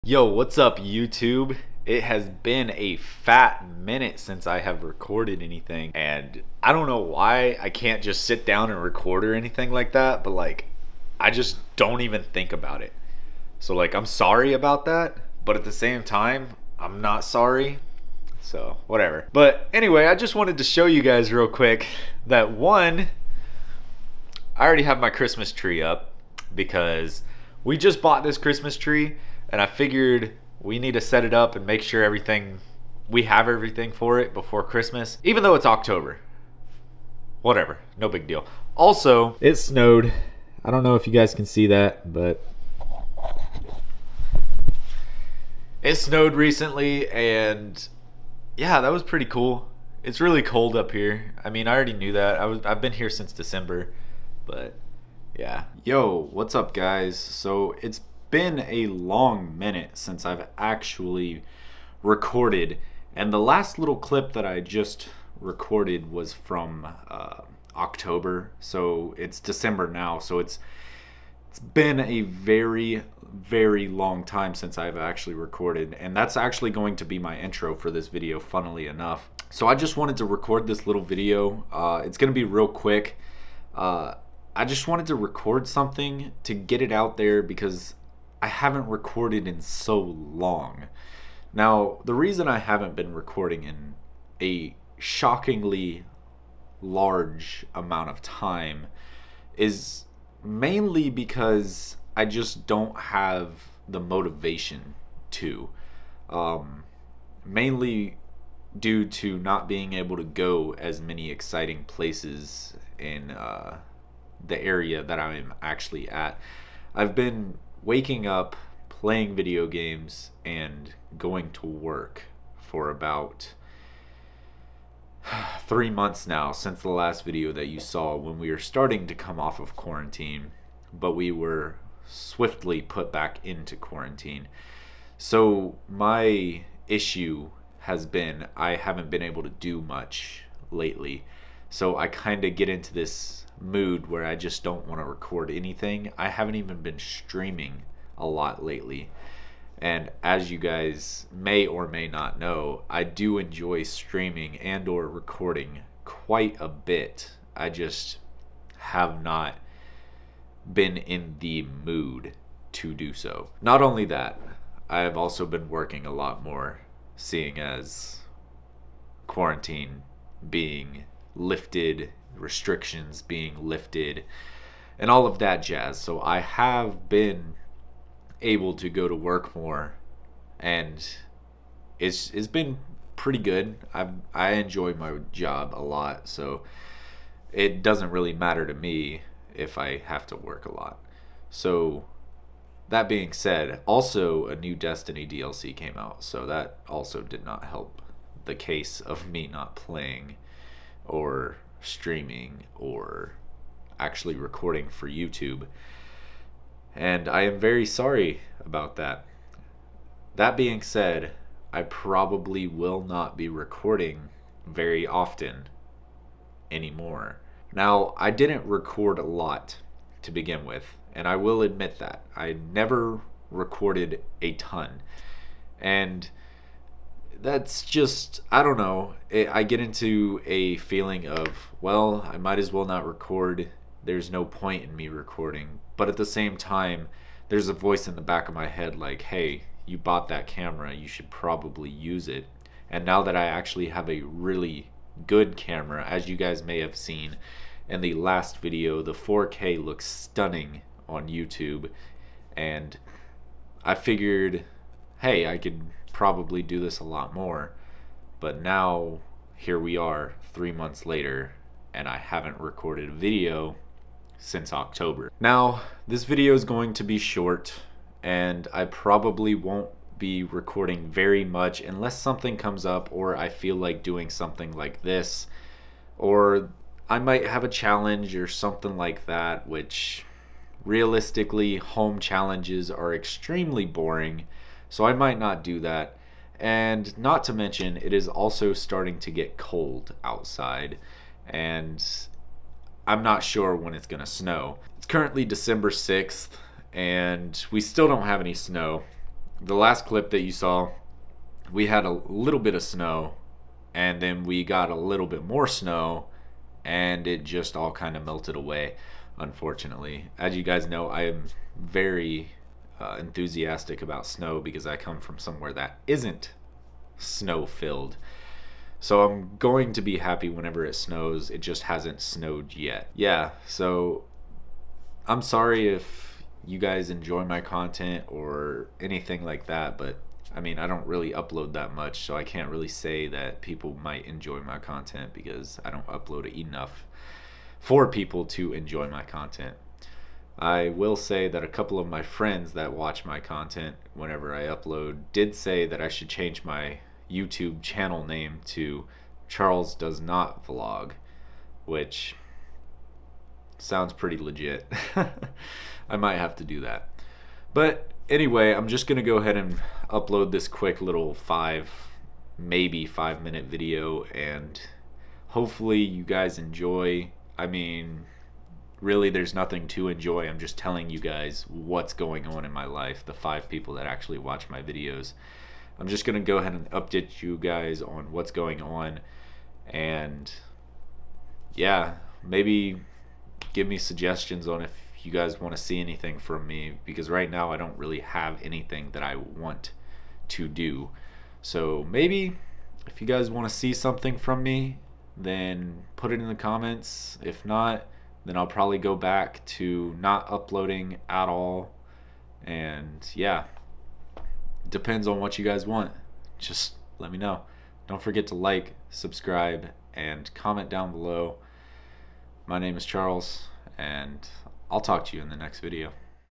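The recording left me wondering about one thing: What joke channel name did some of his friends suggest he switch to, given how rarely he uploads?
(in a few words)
Charles Does Not Vlog.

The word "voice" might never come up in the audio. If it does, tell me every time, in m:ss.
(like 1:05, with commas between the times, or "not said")
3:57.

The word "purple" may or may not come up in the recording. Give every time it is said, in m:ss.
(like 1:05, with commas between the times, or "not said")
not said.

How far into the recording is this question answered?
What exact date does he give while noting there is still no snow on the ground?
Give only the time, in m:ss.
4:55.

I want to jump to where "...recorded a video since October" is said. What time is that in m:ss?
4:22.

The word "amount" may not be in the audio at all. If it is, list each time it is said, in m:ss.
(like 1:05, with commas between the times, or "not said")
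1:37.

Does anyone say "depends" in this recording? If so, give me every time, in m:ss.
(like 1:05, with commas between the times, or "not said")
6:44.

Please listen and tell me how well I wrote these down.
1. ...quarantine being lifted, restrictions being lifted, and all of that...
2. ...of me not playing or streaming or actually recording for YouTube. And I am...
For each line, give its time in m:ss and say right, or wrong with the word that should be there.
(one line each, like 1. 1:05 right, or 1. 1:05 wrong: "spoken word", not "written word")
1. 2:49 right
2. 3:19 right.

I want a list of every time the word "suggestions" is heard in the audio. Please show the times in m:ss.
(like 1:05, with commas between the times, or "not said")
6:23.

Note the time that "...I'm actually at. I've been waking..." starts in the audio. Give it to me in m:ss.
1:55.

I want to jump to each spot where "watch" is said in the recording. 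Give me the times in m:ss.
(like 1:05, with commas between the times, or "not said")
5:42, 6:14.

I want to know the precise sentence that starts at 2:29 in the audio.
And as you guys may or may not know, I do enjoy streaming and or recording quite a bit.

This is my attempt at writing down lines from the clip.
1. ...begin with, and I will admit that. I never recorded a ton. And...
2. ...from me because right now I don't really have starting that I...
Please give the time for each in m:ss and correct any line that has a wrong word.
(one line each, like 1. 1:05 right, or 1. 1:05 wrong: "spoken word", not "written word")
1. 3:40 right
2. 6:26 wrong: "anything", not "starting".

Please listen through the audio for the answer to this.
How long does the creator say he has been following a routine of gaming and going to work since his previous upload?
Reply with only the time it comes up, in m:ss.
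2:05.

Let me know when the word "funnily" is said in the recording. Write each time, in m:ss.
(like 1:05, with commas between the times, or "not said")
1:18.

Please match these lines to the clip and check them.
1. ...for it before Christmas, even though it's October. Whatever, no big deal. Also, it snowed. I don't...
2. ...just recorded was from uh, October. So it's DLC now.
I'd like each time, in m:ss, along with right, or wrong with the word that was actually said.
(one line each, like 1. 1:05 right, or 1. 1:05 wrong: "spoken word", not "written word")
1. 0:33 right
2. 1:04 wrong: "December", not "DLC".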